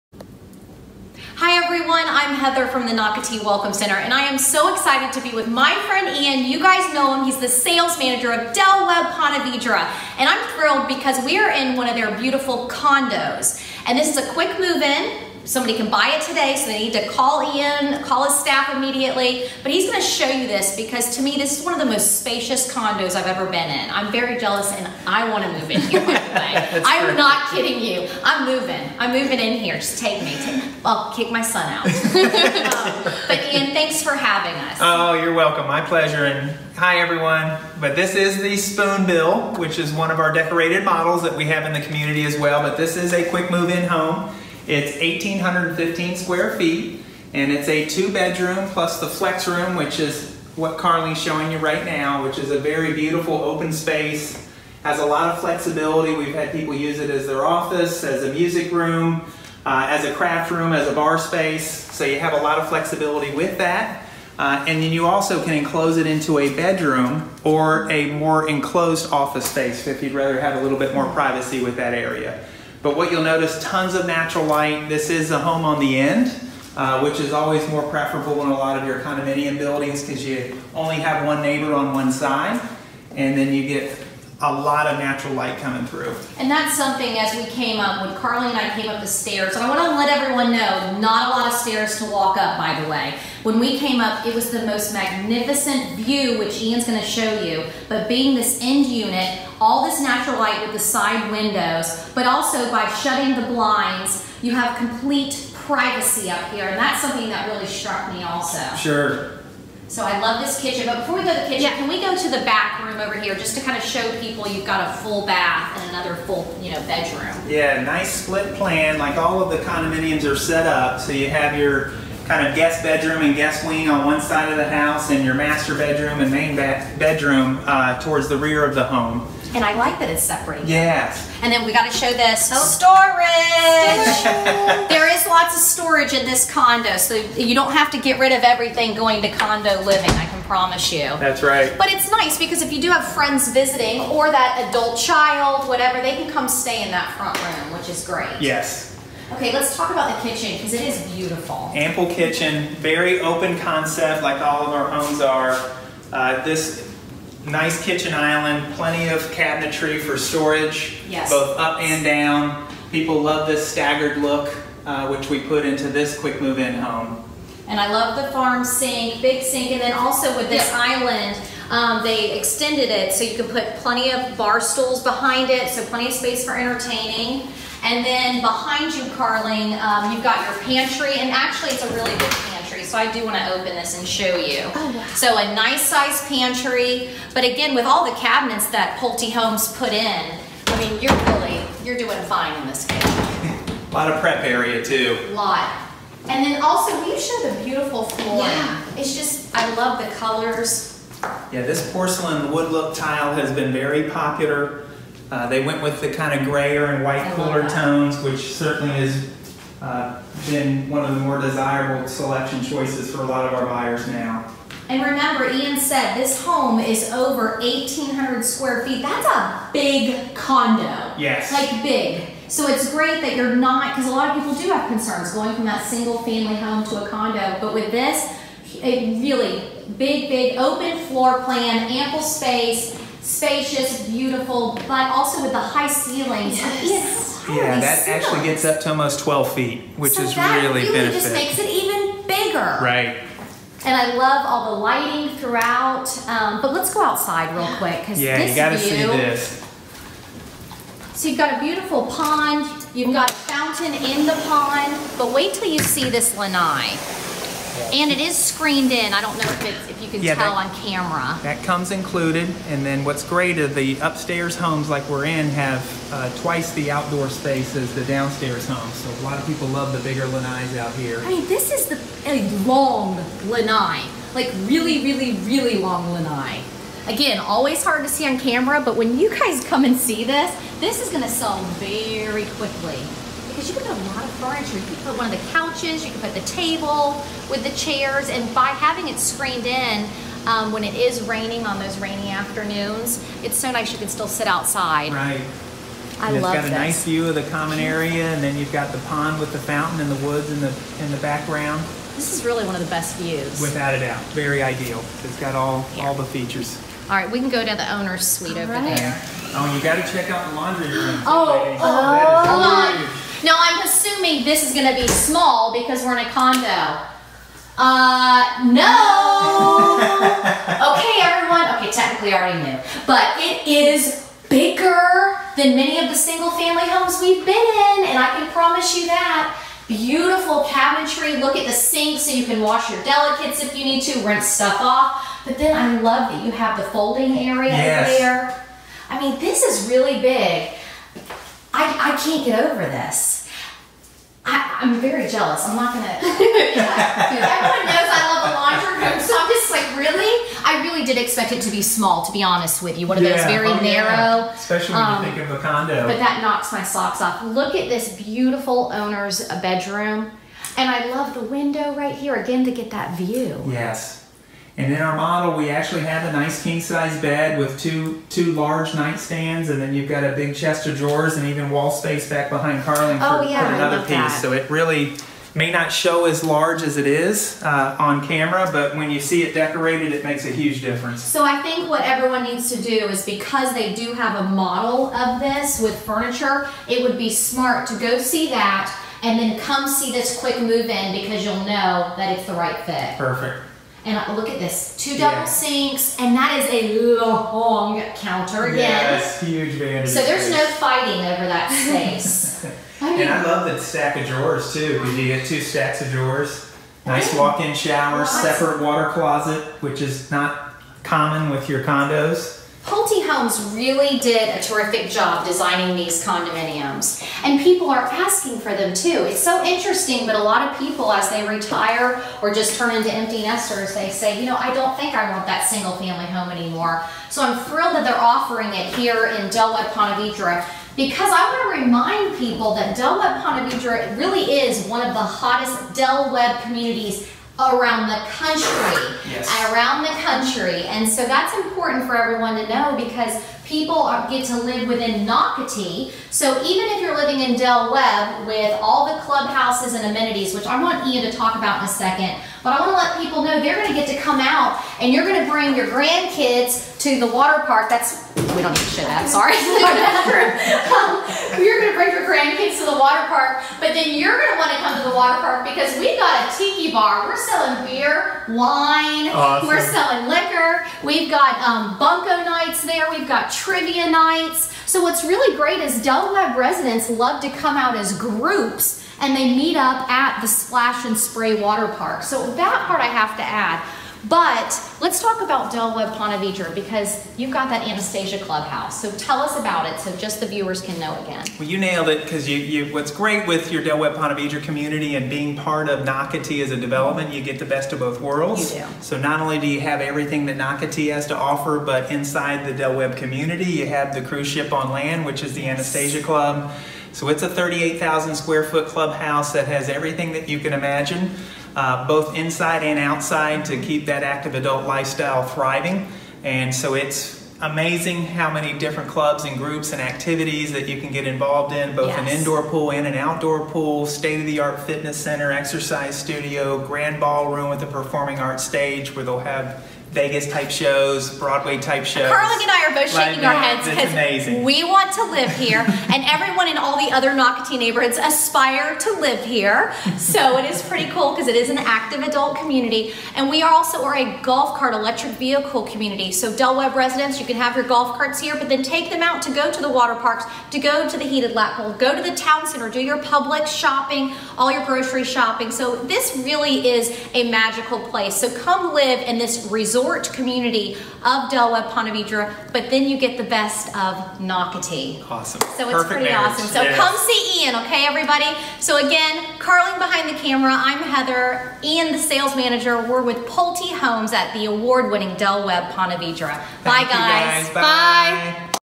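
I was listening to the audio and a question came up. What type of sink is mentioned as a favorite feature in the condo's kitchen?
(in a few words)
farm sink.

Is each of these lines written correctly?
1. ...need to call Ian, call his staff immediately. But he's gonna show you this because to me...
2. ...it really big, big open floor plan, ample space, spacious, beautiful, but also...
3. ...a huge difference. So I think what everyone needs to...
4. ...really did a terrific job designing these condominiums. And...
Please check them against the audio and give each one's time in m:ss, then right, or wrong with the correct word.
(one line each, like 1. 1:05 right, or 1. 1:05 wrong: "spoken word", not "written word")
1. 0:16 right
2. 3:48 right
3. 6:20 right
4. 6:53 right.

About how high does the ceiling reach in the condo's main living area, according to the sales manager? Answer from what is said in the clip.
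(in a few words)
almost 12 feet.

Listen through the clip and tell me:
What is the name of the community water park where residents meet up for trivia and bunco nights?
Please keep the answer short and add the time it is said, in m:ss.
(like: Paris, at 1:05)
Splash and Spray Water Park, at 8:00.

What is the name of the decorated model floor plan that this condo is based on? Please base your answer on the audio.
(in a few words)
Spoonbill.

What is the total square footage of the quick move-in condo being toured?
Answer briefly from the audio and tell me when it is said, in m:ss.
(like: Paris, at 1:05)
1,815, at 0:44.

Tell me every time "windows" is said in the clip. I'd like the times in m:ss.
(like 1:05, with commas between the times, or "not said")
1:41, 6:01.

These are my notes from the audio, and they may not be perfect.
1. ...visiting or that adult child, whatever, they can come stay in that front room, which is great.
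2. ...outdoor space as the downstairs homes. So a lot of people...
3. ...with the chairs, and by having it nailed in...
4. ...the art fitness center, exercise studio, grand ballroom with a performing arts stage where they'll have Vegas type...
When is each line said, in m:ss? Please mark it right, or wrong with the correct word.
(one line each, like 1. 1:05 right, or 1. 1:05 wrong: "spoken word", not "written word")
1. 2:23 right
2. 4:26 right
3. 4:47 wrong: "screened", not "nailed"
4. 8:44 right.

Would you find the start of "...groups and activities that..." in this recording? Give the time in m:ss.
8:39.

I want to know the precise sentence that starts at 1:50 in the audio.
But before we go to the kitchen, yeah.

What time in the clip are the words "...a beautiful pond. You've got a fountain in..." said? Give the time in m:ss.
4:11.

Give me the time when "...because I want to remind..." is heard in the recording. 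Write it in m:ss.
7:10.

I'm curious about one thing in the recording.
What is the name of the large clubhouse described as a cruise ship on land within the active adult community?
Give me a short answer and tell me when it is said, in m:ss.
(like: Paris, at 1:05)
Anastasia Club, at 8:25.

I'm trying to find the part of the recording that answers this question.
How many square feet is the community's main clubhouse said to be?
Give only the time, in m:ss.
8:27.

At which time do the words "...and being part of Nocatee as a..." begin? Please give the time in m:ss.
8:15.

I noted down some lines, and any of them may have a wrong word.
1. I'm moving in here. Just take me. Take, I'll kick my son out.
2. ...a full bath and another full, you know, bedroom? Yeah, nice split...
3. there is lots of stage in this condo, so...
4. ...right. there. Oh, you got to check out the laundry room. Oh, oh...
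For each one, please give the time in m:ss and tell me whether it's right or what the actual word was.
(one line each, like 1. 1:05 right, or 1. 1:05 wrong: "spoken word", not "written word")
1. 0:28 right
2. 1:54 right
3. 2:14 wrong: "storage", not "stage"
4. 5:08 right.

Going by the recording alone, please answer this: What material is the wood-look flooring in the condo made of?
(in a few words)
porcelain.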